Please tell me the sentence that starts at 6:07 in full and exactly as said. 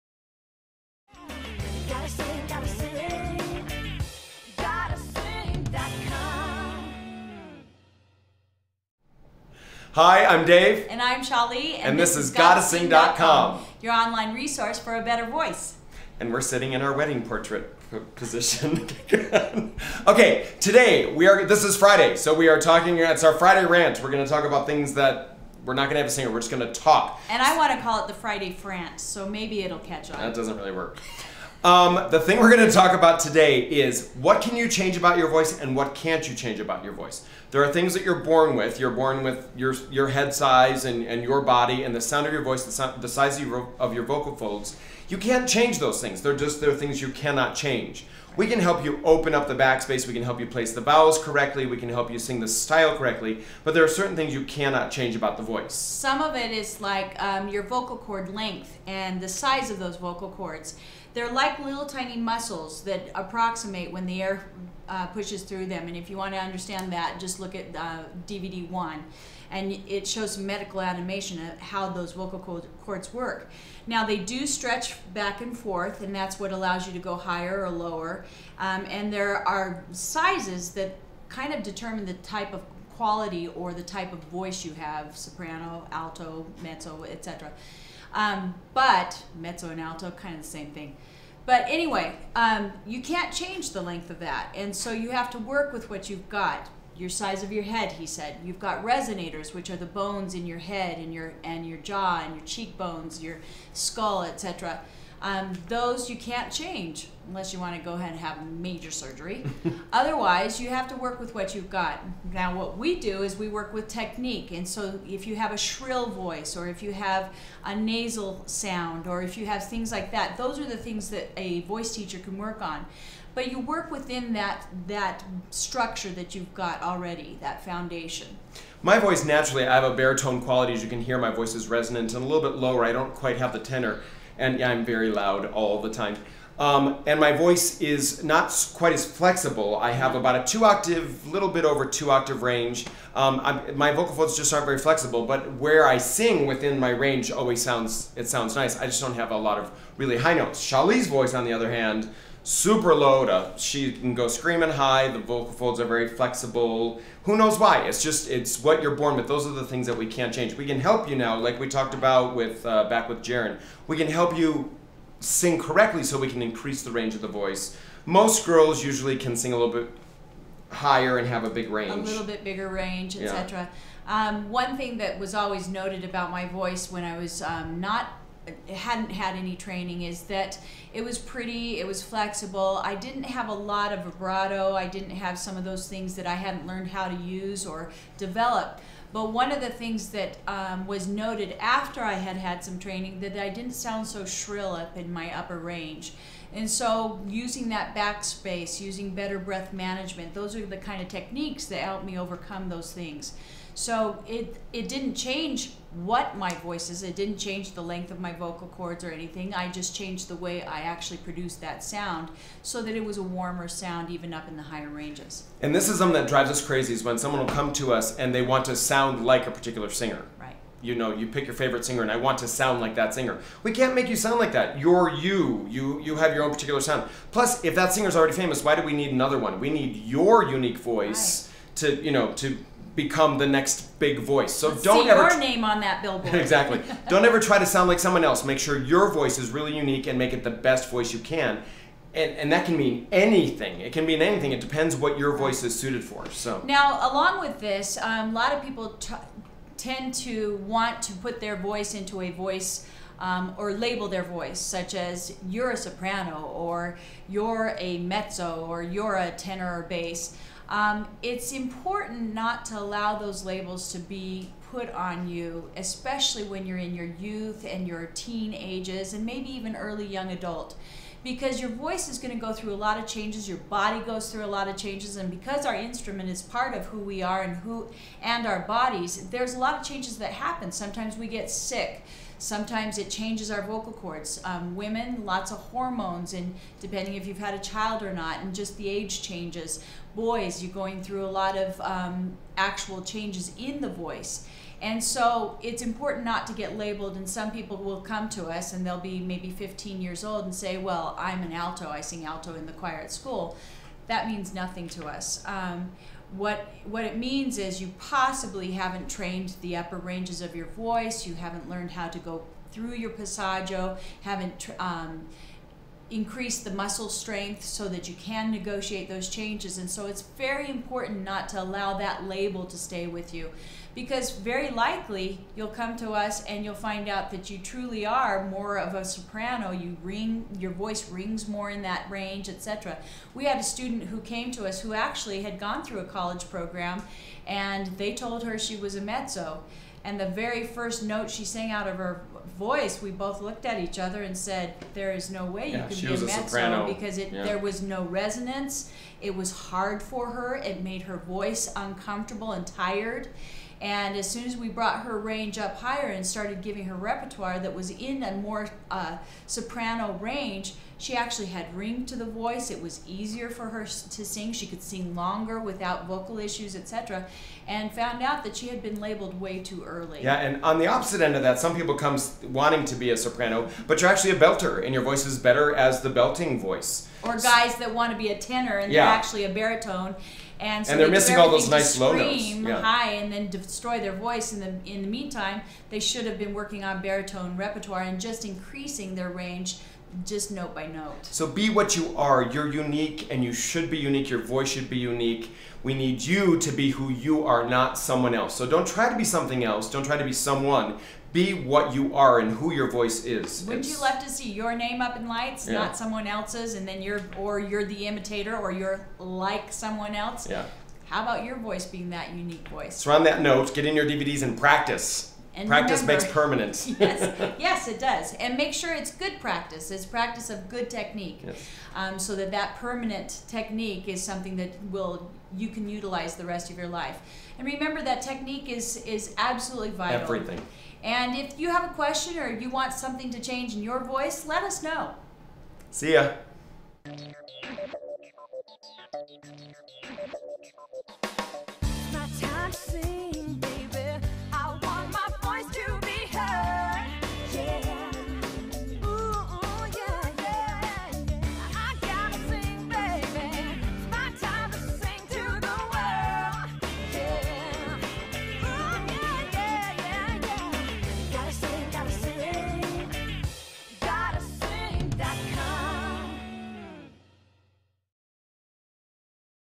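And found out that she had been labeled way too early.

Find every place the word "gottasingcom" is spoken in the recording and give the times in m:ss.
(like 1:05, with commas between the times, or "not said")
0:12.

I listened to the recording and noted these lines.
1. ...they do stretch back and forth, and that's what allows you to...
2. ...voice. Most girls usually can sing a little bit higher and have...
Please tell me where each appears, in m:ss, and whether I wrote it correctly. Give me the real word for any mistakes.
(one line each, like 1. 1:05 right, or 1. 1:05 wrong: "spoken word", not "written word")
1. 1:14 right
2. 2:47 right.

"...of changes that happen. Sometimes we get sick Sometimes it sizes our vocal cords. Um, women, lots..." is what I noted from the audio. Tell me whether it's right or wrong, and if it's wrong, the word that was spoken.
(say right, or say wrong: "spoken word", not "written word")
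wrong: "changes", not "sizes".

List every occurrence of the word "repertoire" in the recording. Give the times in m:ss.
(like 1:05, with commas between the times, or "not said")
5:56, 6:27.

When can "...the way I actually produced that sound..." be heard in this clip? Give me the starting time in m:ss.
3:30.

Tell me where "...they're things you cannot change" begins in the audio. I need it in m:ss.
0:46.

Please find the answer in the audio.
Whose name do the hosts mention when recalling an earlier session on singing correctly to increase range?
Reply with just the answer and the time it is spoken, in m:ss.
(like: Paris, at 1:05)
Jaren, at 2:43.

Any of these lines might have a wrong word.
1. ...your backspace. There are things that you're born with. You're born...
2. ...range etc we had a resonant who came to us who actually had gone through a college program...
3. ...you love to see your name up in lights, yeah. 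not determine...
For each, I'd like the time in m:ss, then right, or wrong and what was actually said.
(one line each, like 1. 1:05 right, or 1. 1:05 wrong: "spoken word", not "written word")
1. 0:36 wrong: "voice", not "backspace"
2. 5:32 wrong: "student", not "resonant"
3. 6:43 wrong: "someone", not "determine".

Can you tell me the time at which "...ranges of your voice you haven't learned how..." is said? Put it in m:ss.
5:09.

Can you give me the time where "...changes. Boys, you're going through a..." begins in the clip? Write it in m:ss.
4:49.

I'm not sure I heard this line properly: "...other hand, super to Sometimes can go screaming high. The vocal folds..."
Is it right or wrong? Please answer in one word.
wrong.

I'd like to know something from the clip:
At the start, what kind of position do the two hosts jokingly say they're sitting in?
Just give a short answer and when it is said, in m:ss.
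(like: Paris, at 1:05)
wedding portrait position, at 0:16.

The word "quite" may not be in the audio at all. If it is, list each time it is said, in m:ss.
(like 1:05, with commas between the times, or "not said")
2:13, 2:18.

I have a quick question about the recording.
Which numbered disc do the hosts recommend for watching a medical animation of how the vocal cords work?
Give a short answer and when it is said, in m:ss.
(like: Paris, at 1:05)
DVD 1, at 1:08.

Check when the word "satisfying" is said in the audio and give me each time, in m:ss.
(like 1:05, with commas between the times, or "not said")
not said.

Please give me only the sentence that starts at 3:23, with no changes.
So it it didn't change what my voice is.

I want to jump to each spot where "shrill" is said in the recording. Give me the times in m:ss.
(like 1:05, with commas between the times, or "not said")
1:55, 3:14.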